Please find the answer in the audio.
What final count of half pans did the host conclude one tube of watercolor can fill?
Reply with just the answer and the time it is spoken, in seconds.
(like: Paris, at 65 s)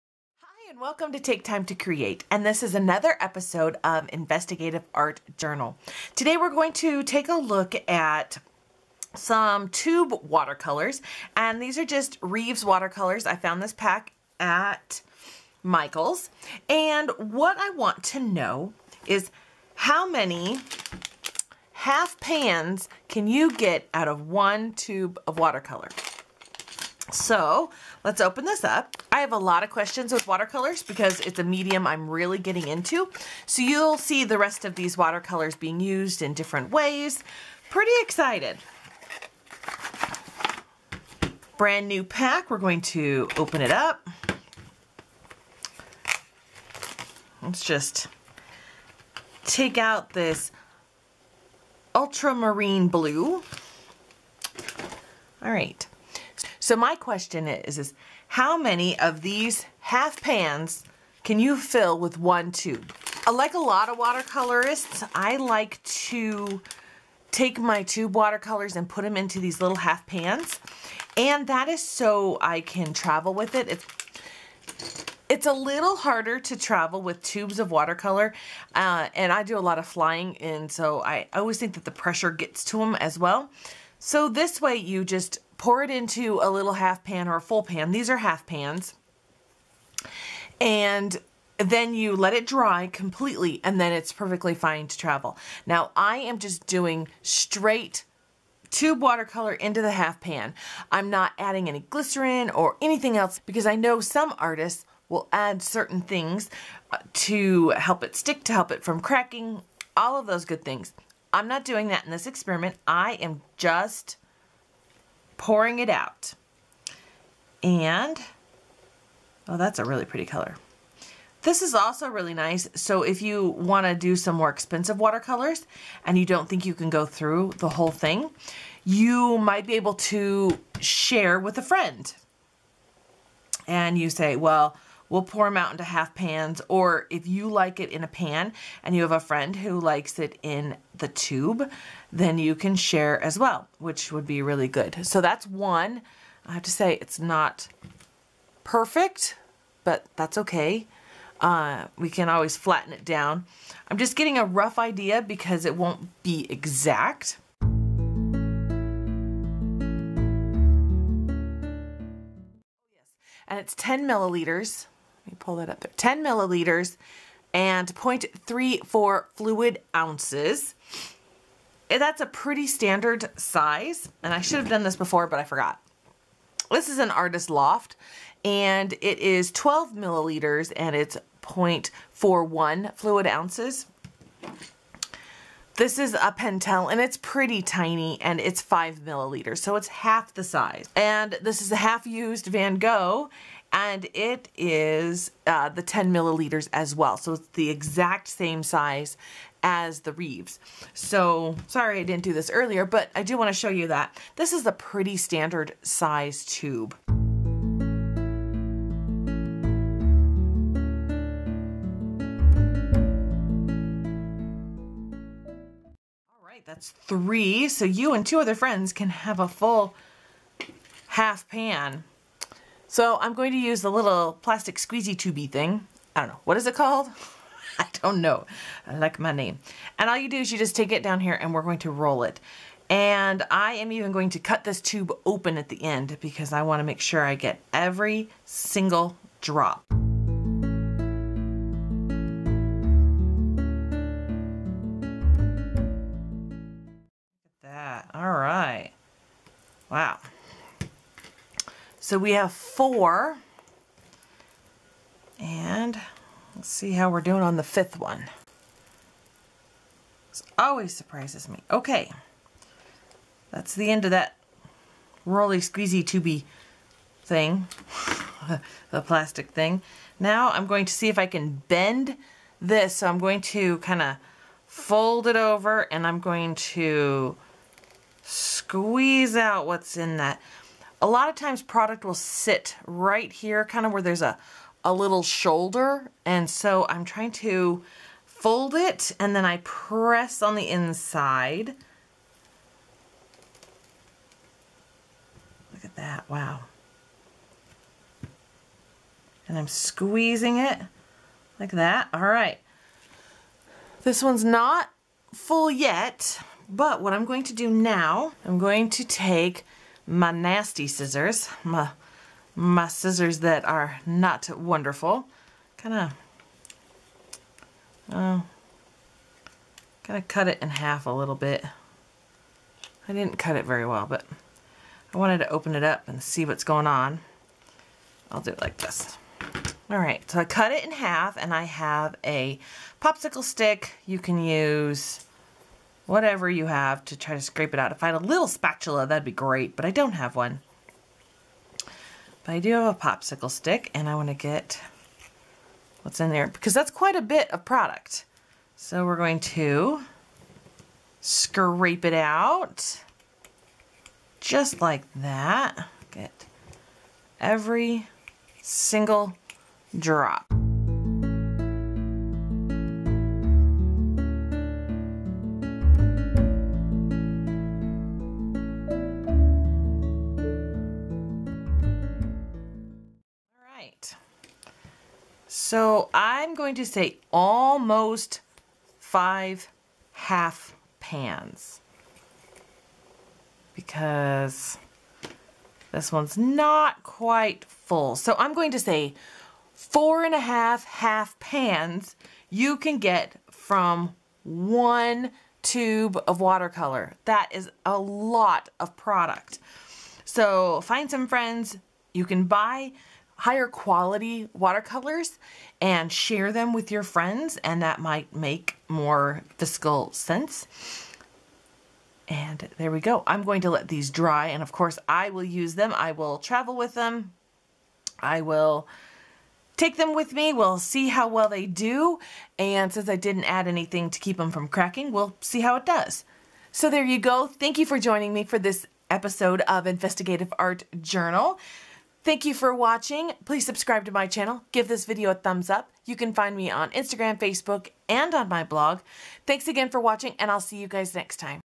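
4.5, at 389 s.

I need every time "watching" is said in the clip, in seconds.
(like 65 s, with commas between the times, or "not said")
432 s, 439 s.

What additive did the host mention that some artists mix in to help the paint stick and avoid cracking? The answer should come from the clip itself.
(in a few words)
glycerin.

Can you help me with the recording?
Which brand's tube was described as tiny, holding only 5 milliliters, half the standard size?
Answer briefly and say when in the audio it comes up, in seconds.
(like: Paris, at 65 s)
Pentel, at 186 s.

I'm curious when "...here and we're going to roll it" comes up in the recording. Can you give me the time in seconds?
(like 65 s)
231 s.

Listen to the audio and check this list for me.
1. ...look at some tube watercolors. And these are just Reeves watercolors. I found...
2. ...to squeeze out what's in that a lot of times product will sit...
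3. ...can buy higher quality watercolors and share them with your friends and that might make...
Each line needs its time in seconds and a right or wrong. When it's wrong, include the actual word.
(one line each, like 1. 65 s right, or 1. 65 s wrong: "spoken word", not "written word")
1. 7 s right
2. 276 s right
3. 402 s right.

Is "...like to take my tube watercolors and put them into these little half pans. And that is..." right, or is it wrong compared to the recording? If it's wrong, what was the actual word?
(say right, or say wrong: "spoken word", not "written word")
right.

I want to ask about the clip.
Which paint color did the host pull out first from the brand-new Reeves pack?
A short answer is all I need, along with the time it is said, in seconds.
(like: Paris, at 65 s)
ultramarine blue, at 51 s.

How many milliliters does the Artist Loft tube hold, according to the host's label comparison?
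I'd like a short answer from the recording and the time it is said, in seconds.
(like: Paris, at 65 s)
12 milliliters, at 179 s.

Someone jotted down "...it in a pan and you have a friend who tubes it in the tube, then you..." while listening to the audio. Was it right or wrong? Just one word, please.
wrong.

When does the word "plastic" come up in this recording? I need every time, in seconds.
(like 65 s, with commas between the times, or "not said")
224 s, 269 s.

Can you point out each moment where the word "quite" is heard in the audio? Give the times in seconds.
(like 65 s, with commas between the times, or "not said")
346 s, 387 s.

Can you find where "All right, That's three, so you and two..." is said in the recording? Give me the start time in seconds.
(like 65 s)
216 s.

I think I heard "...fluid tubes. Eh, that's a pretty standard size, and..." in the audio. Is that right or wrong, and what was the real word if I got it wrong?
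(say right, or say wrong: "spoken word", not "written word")
wrong: "ounces", not "tubes".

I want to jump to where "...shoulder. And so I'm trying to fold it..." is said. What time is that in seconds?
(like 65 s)
285 s.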